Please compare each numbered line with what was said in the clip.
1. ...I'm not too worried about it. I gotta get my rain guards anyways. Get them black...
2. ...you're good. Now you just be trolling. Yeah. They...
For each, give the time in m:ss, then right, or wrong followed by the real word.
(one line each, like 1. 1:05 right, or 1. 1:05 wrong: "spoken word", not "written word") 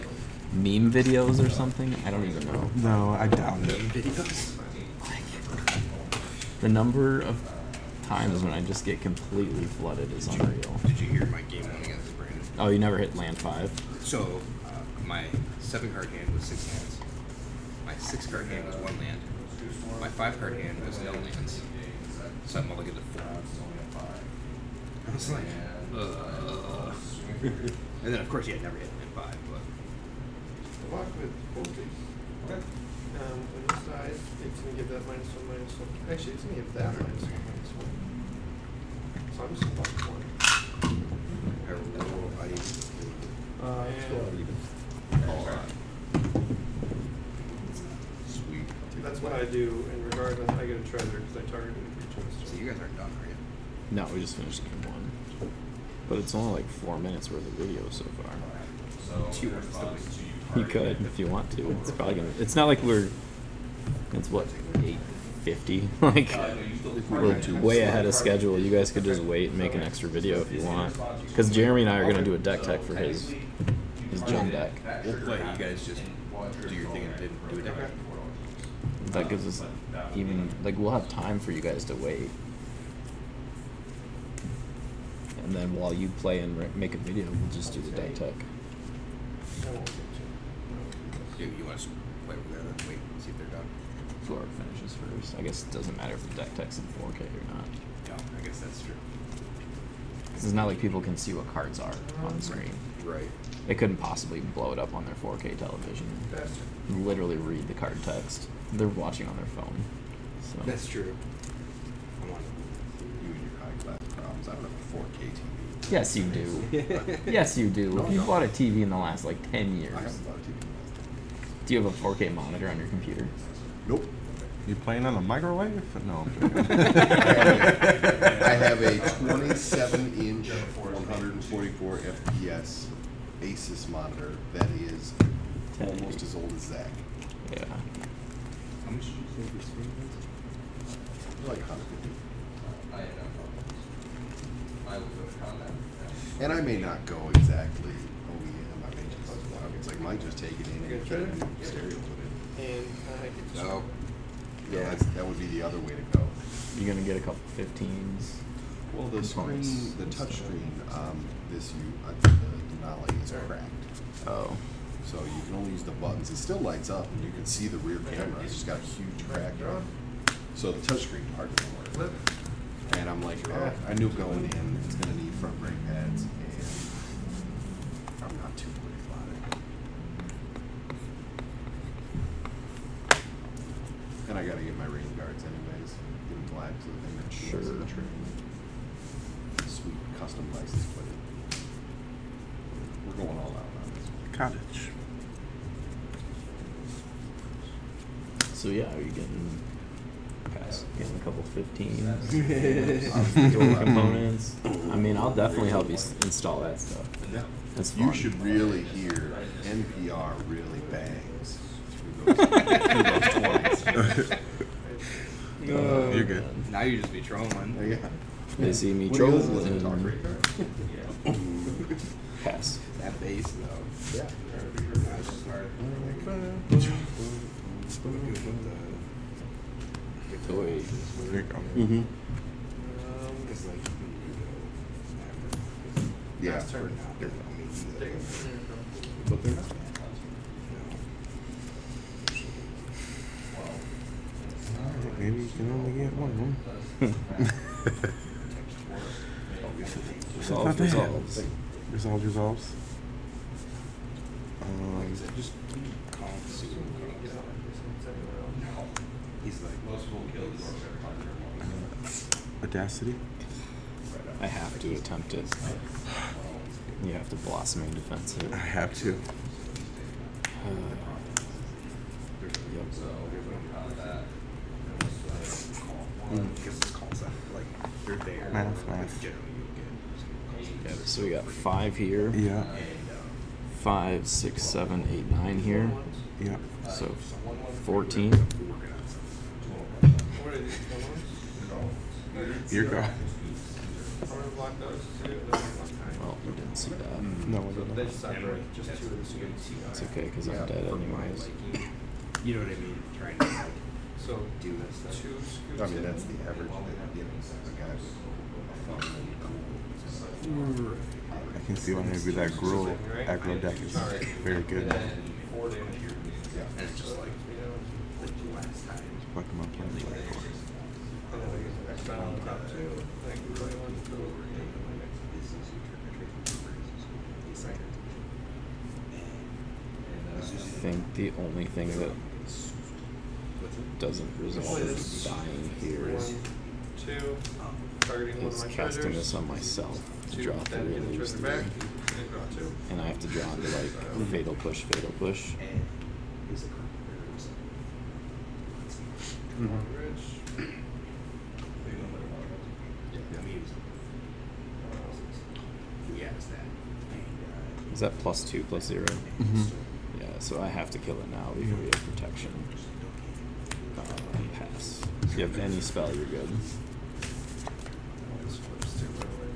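1. 2:58 right
2. 3:36 right.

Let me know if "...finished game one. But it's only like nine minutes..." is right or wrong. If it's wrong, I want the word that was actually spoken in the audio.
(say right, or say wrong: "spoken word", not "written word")
wrong: "four", not "nine".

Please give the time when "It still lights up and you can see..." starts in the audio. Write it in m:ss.
2:46.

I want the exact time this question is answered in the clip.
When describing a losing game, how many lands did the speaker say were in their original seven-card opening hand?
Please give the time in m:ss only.
0:16.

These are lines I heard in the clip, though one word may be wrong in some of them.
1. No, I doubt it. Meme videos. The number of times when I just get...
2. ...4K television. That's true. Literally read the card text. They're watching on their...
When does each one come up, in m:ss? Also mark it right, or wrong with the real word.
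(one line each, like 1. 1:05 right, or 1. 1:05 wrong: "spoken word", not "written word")
1. 0:02 right
2. 1:45 right.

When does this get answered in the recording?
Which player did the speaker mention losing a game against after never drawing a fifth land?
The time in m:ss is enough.
0:12.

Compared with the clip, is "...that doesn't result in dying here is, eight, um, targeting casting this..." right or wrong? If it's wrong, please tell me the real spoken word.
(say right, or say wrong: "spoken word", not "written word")
wrong: "two", not "eight".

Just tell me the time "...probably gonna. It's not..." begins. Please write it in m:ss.
1:01.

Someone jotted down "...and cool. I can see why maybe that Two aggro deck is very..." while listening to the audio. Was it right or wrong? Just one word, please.
wrong.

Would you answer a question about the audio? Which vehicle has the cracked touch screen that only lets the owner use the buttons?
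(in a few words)
Denali.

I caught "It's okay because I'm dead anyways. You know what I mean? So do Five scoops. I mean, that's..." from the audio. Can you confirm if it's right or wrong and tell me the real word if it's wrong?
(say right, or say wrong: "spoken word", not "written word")
wrong: "Two", not "Five".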